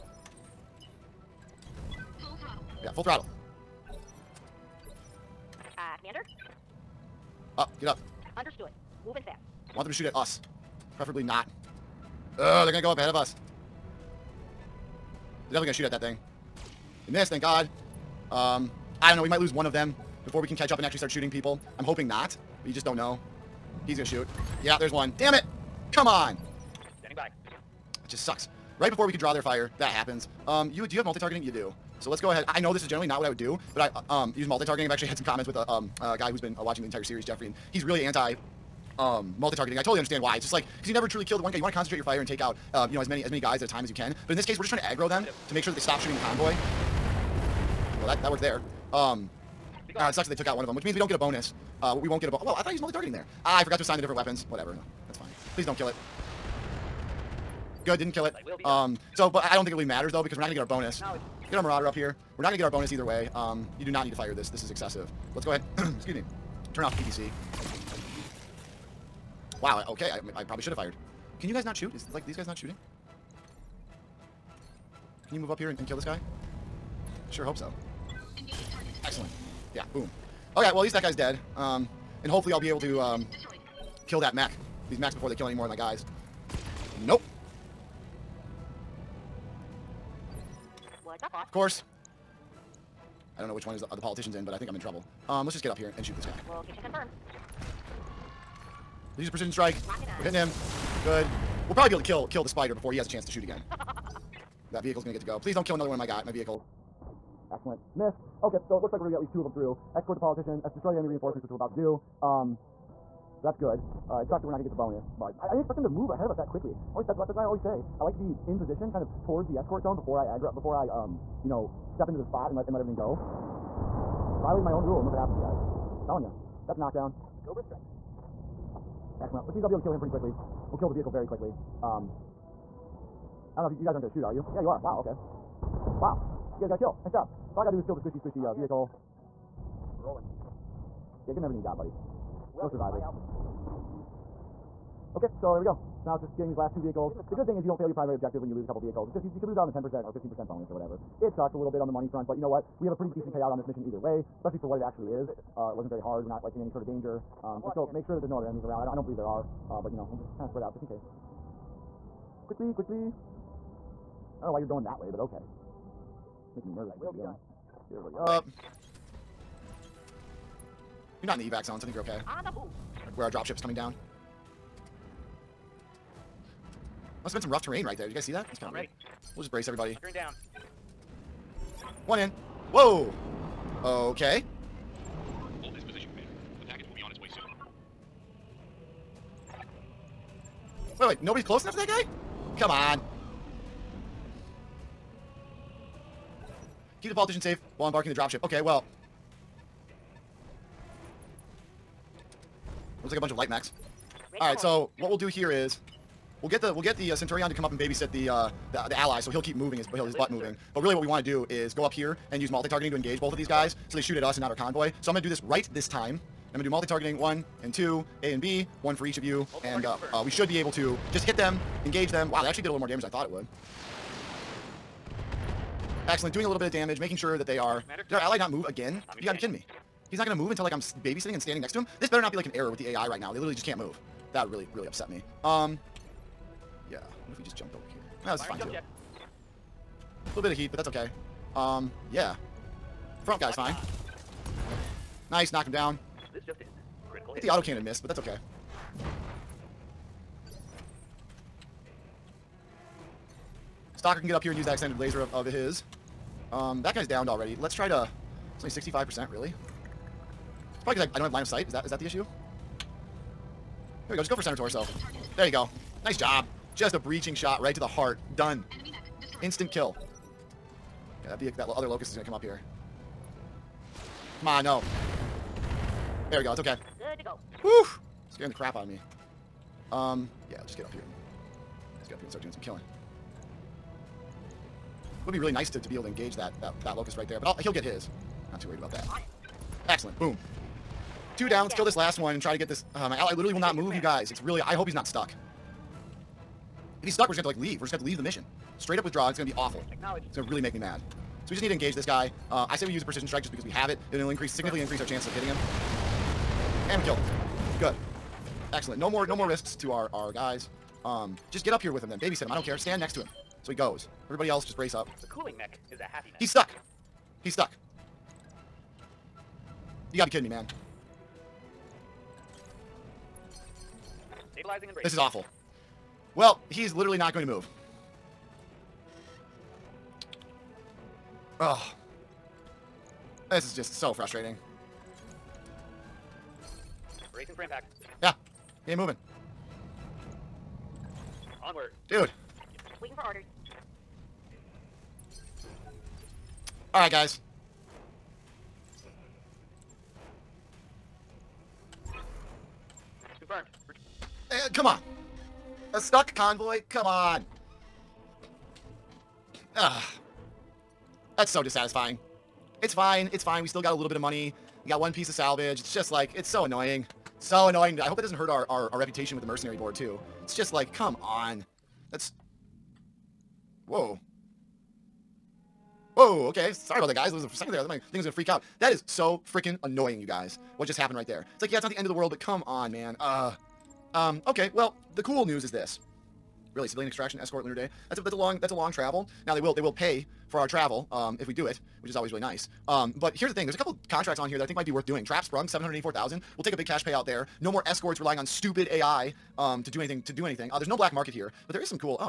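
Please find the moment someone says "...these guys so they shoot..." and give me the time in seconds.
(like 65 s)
213 s.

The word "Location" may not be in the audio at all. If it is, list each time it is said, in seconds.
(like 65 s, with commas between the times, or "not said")
96 s.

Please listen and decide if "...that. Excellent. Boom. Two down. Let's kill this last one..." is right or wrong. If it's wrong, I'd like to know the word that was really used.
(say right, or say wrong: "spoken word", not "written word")
right.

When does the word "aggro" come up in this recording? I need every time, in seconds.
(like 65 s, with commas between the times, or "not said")
44 s, 120 s.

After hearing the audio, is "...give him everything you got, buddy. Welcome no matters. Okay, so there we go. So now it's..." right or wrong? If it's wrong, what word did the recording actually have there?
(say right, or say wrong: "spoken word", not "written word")
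wrong: "survivors", not "matters".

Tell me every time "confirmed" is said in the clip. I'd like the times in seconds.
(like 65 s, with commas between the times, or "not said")
96 s, 353 s.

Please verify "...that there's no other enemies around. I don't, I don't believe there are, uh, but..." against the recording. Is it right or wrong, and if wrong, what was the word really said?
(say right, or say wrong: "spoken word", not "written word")
right.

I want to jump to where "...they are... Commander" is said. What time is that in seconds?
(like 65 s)
227 s.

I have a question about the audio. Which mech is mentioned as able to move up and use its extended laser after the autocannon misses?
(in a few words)
Stalker.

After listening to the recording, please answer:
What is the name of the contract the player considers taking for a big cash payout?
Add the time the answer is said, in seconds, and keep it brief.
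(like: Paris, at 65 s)
Trap Sprung, at 395 s.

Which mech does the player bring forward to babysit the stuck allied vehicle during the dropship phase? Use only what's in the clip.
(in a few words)
Centurion.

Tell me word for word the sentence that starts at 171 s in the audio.
You're not in the evac zone, so I think you're okay.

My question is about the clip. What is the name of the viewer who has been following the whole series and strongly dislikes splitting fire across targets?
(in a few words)
Jeffrey.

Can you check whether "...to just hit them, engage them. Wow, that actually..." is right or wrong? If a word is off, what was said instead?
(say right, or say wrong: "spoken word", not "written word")
right.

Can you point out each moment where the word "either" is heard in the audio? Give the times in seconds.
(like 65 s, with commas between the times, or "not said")
62 s, 153 s.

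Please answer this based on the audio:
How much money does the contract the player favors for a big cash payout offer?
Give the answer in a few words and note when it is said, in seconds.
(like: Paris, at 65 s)
784,000, at 395 s.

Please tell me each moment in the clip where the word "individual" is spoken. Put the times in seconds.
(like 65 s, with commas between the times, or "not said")
not said.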